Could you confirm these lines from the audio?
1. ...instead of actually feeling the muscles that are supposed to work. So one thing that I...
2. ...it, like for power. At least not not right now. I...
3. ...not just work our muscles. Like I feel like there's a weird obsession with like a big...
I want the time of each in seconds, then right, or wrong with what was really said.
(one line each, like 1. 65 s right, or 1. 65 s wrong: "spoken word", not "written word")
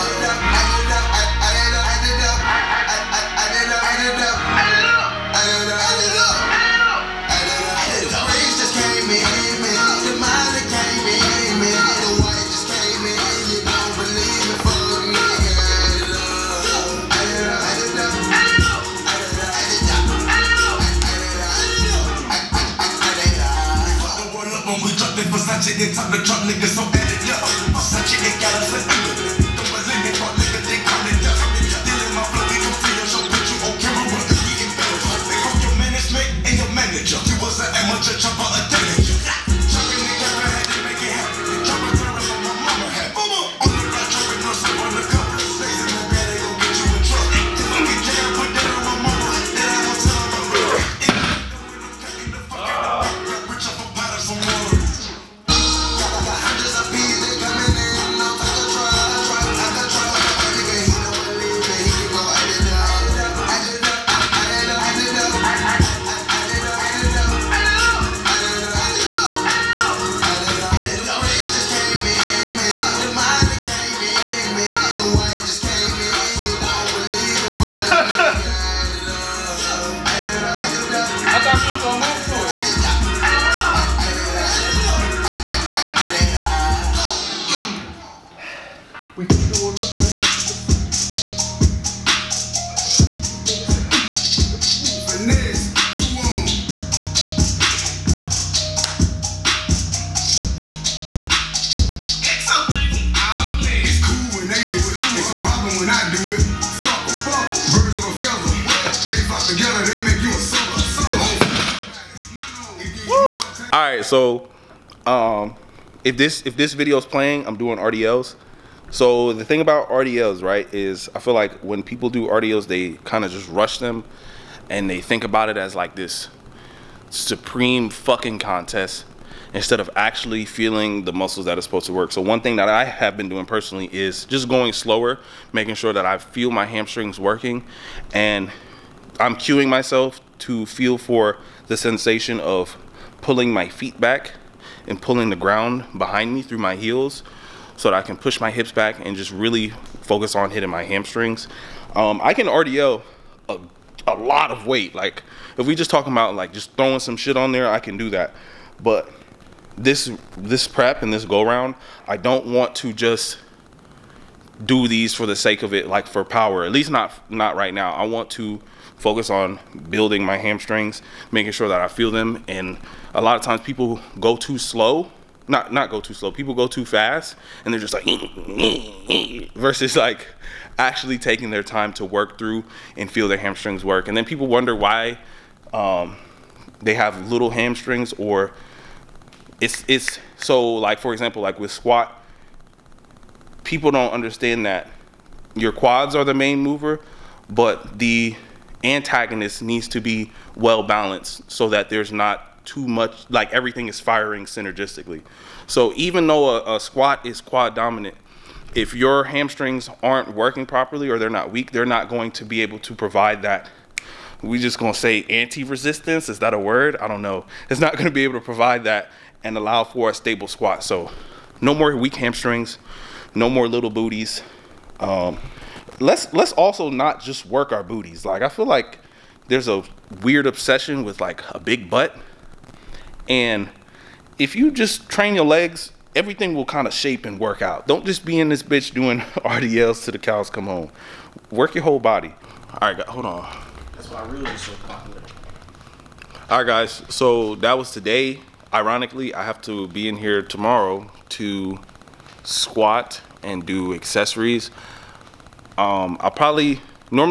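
1. 129 s right
2. 165 s right
3. 226 s wrong: "booties", not "muscles".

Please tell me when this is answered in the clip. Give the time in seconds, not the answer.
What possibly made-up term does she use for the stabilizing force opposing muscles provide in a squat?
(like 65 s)
215 s.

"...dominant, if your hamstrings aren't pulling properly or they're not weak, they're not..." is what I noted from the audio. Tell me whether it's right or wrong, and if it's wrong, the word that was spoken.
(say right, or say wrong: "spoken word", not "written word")
wrong: "working", not "pulling".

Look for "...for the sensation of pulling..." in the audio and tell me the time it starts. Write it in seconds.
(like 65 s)
140 s.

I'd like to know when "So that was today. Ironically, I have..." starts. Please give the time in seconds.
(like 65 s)
247 s.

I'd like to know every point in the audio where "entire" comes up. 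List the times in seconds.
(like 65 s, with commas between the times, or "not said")
not said.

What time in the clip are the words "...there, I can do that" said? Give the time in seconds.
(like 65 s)
157 s.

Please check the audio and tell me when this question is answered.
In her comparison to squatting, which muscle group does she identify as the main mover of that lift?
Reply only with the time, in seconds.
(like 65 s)
195 s.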